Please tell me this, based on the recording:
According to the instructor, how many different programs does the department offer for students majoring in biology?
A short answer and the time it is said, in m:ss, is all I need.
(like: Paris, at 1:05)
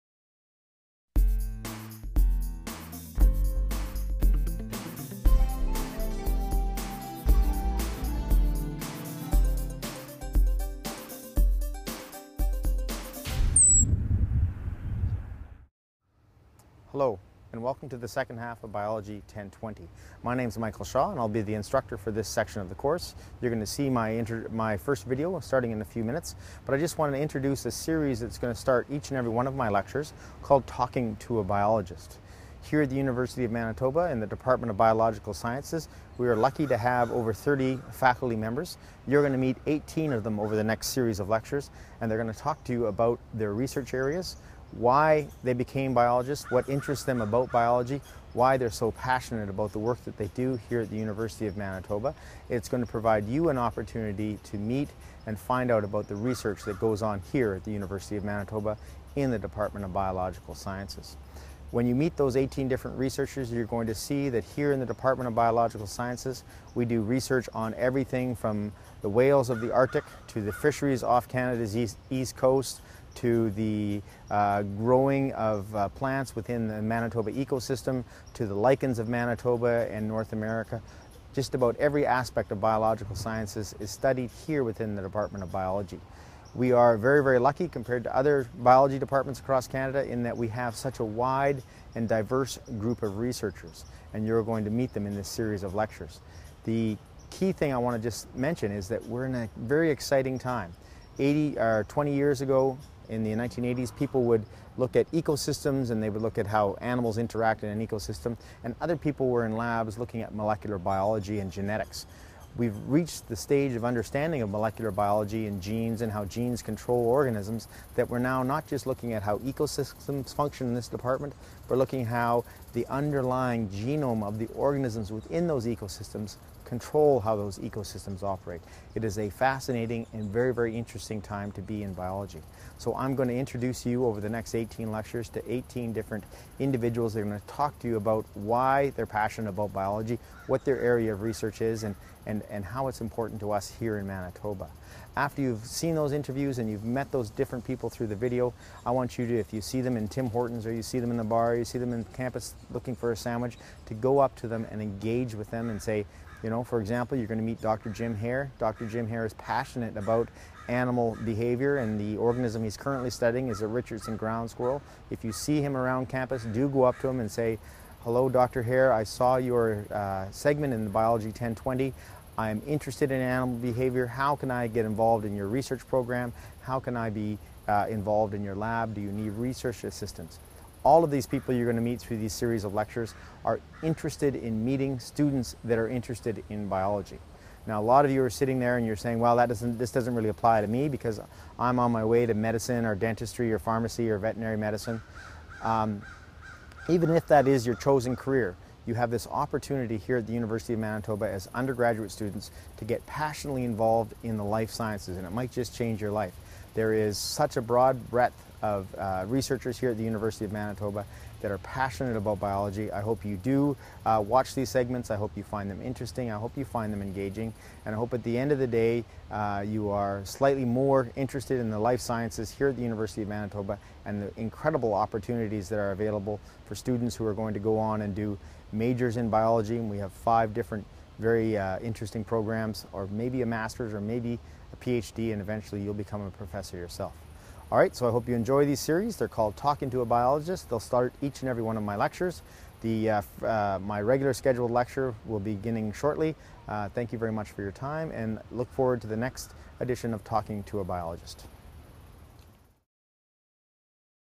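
5, at 3:50.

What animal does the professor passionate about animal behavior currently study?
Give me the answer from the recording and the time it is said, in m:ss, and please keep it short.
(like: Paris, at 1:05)
Richardson ground squirrel, at 2:43.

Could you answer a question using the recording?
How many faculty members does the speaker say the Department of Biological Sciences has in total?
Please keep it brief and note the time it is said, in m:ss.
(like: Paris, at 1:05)
over 30, at 0:37.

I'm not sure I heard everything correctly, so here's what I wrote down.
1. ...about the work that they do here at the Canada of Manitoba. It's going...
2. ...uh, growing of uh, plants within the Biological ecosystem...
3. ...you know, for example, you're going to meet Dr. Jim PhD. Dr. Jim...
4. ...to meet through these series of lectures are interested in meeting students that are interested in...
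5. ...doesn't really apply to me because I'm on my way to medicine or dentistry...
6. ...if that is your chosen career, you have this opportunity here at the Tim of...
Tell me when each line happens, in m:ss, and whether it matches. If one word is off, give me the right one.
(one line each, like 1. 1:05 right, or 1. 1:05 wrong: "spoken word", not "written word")
1. 0:49 wrong: "University", not "Canada"
2. 1:14 wrong: "Manitoba", not "Biological"
3. 2:36 wrong: "Hare", not "PhD"
4. 3:01 right
5. 3:09 right
6. 3:17 wrong: "University", not "Tim".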